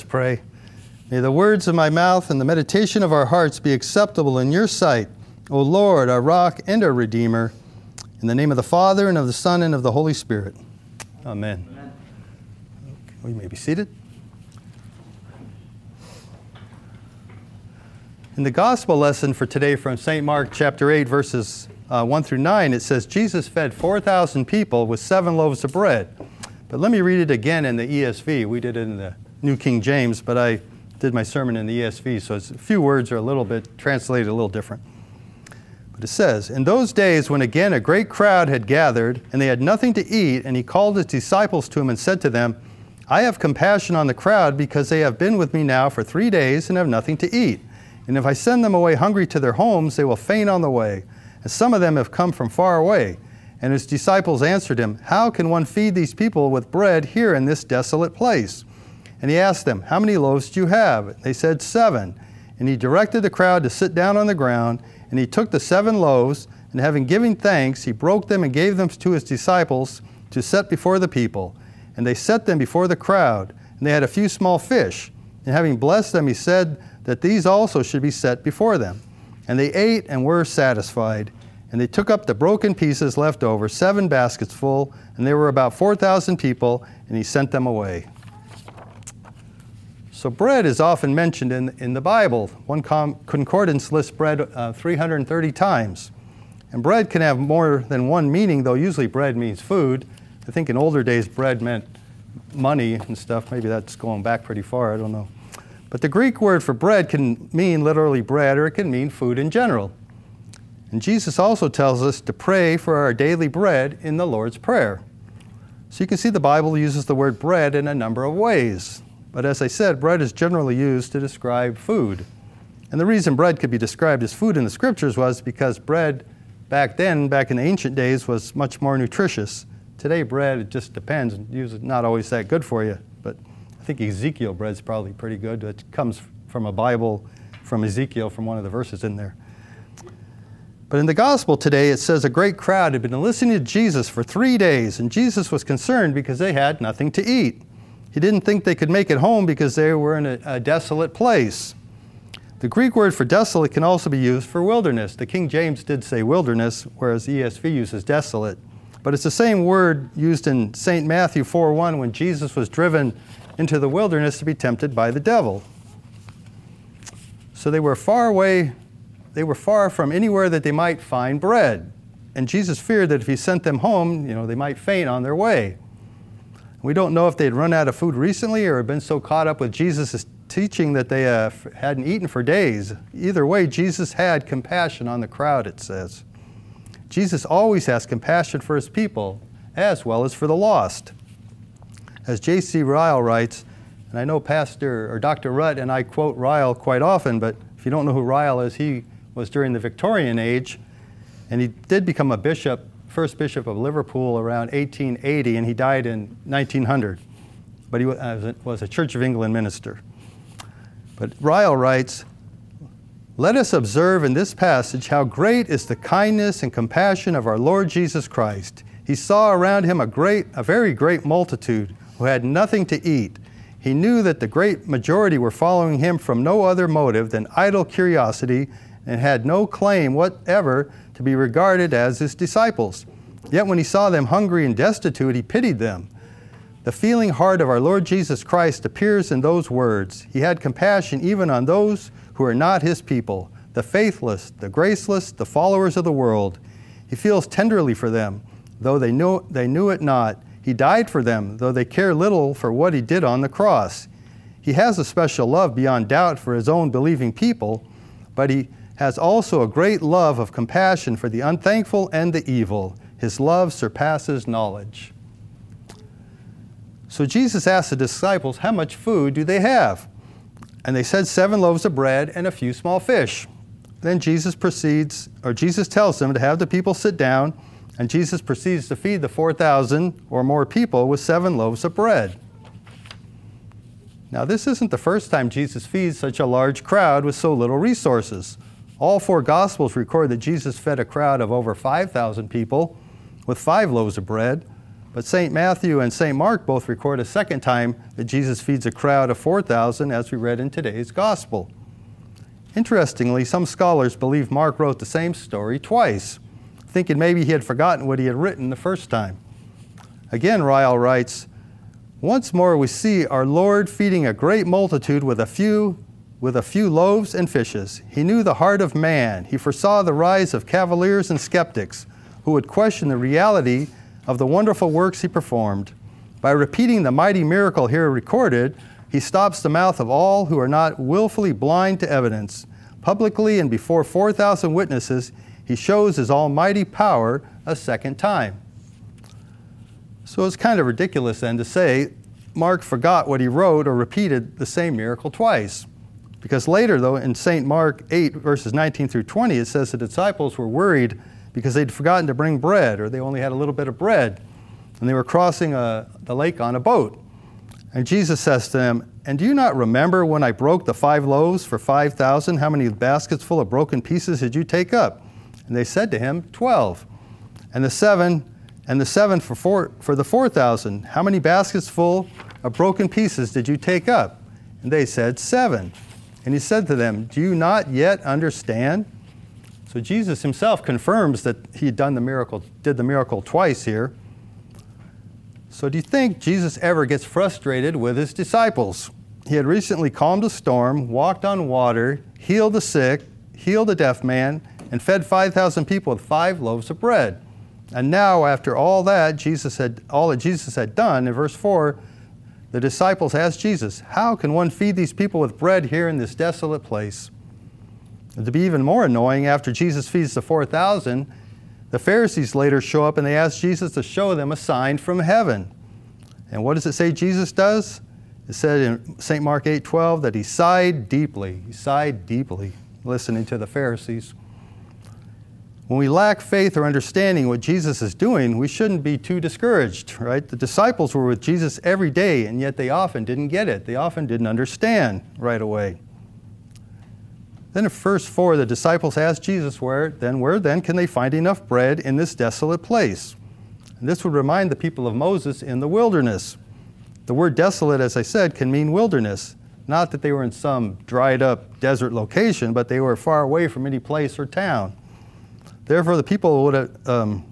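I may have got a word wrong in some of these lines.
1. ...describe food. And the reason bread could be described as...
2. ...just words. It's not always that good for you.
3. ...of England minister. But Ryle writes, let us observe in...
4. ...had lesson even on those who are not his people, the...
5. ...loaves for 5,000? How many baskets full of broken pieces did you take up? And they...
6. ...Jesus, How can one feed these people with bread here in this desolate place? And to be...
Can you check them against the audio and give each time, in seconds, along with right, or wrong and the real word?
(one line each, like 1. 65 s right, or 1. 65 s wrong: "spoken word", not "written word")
1. 121 s right
2. 130 s wrong: "depends", not "words"
3. 209 s right
4. 240 s wrong: "compassion", not "lesson"
5. 361 s right
6. 403 s right.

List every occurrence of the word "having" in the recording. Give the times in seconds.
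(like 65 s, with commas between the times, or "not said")
66 s, 75 s.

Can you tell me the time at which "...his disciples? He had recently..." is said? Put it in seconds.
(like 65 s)
388 s.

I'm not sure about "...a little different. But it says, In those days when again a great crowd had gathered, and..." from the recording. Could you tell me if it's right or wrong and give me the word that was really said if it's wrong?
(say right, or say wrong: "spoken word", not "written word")
right.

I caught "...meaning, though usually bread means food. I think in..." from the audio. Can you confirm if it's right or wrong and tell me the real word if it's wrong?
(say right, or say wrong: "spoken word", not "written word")
right.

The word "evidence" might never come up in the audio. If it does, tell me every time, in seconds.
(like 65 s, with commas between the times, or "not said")
332 s.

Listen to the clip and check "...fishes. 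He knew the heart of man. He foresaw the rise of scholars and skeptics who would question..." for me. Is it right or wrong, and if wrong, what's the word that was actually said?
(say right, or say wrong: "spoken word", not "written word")
wrong: "cavaliers", not "scholars".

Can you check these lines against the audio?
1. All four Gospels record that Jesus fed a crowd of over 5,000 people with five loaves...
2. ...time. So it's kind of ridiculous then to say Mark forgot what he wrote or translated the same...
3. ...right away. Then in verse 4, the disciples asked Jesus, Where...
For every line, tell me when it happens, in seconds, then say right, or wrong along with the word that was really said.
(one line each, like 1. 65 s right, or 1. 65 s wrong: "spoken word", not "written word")
1. 289 s right
2. 338 s wrong: "repeated", not "translated"
3. 435 s right.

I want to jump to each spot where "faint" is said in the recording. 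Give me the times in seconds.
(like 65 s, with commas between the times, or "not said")
50 s, 174 s.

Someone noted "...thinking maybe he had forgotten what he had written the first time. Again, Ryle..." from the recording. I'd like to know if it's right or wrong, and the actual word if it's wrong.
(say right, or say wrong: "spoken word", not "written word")
right.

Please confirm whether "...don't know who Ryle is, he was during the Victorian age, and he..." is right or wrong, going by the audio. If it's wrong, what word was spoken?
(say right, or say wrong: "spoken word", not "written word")
right.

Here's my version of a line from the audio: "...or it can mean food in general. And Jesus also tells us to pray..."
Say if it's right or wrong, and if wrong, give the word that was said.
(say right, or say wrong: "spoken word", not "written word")
right.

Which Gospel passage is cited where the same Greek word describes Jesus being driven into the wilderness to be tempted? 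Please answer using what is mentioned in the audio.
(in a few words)
Matthew 4:1.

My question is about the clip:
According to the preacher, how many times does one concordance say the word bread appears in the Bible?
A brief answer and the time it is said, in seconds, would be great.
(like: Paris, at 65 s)
330, at 94 s.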